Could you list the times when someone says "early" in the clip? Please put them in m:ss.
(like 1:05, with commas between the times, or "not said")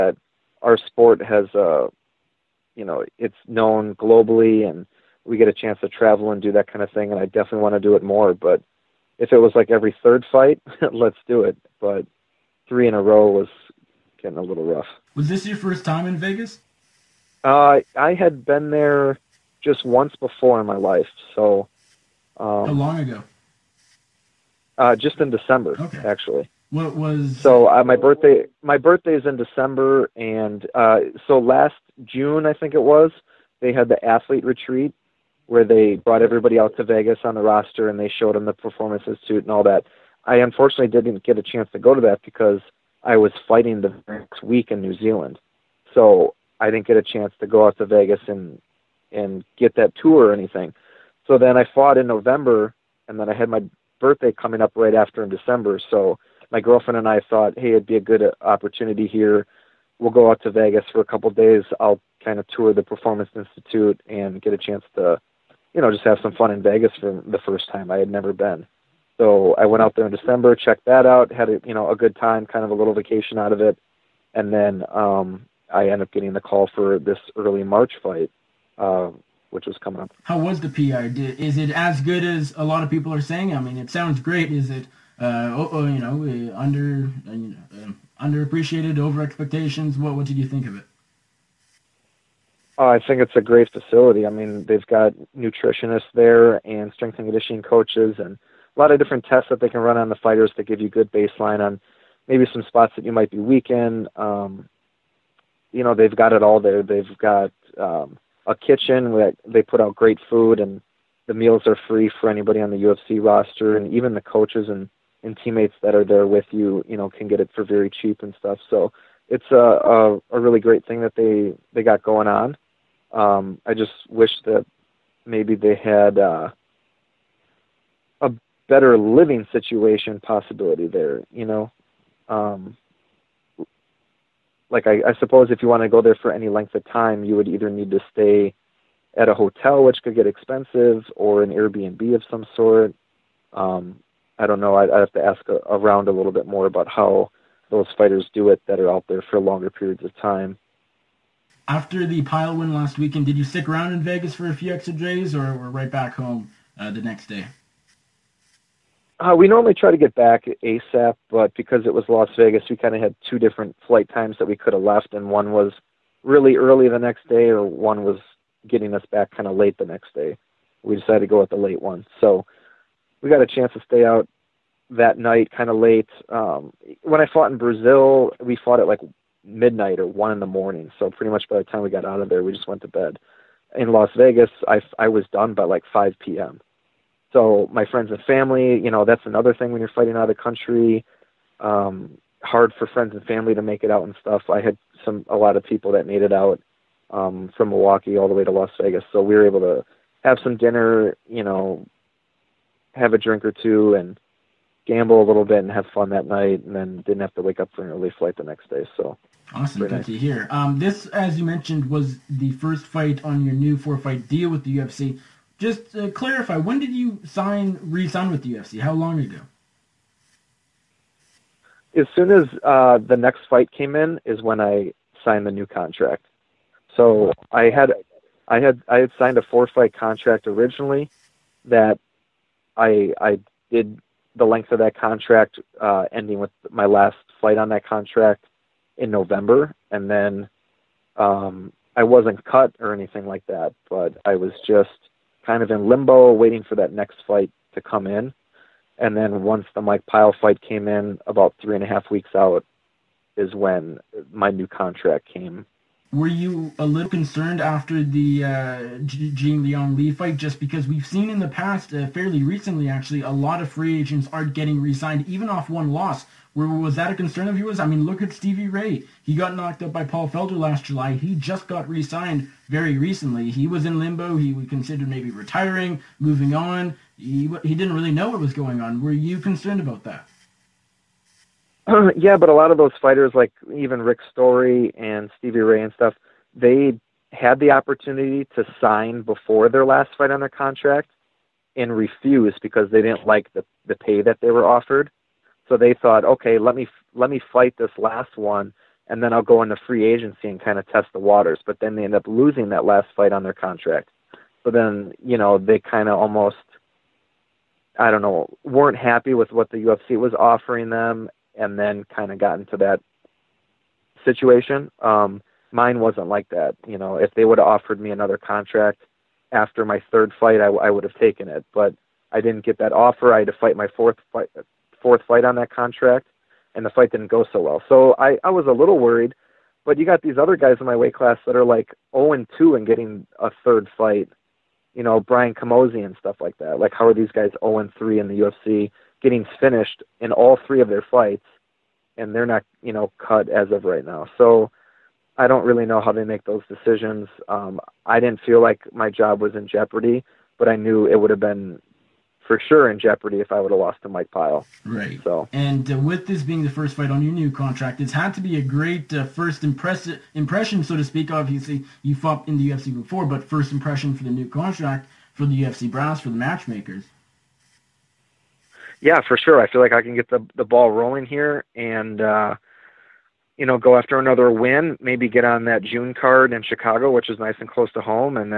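1:17, 2:46, 3:27.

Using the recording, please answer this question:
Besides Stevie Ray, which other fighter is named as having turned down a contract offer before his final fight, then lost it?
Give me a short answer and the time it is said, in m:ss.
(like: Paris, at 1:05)
Rick Story, at 4:44.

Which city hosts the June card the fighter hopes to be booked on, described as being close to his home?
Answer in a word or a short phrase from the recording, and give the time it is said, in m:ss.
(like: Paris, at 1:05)
Chicago, at 6:16.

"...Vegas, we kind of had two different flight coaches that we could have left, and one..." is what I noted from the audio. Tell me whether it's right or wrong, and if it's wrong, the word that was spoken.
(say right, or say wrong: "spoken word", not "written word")
wrong: "times", not "coaches".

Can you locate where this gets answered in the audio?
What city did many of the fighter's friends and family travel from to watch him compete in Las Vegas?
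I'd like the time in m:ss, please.
3:17.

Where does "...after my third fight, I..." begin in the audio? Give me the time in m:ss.
5:19.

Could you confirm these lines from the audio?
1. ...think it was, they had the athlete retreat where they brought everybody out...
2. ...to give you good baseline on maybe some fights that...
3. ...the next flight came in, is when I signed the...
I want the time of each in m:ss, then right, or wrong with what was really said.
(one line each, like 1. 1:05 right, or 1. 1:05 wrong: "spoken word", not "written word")
1. 0:32 right
2. 1:40 wrong: "spots", not "fights"
3. 3:42 wrong: "fight", not "flight".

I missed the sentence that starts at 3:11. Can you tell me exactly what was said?
Um, hard for friends and family to make it out and stuff.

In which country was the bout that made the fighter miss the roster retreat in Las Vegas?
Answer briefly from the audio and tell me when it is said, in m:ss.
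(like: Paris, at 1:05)
New Zealand, at 0:44.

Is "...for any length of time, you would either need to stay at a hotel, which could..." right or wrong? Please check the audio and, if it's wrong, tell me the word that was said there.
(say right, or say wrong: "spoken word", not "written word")
right.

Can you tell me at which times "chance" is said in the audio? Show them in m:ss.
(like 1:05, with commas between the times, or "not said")
0:05, 0:41, 0:47, 1:04, 2:53.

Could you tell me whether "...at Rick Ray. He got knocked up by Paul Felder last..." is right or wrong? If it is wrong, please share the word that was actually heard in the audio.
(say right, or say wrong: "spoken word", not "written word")
wrong: "Stevie", not "Rick".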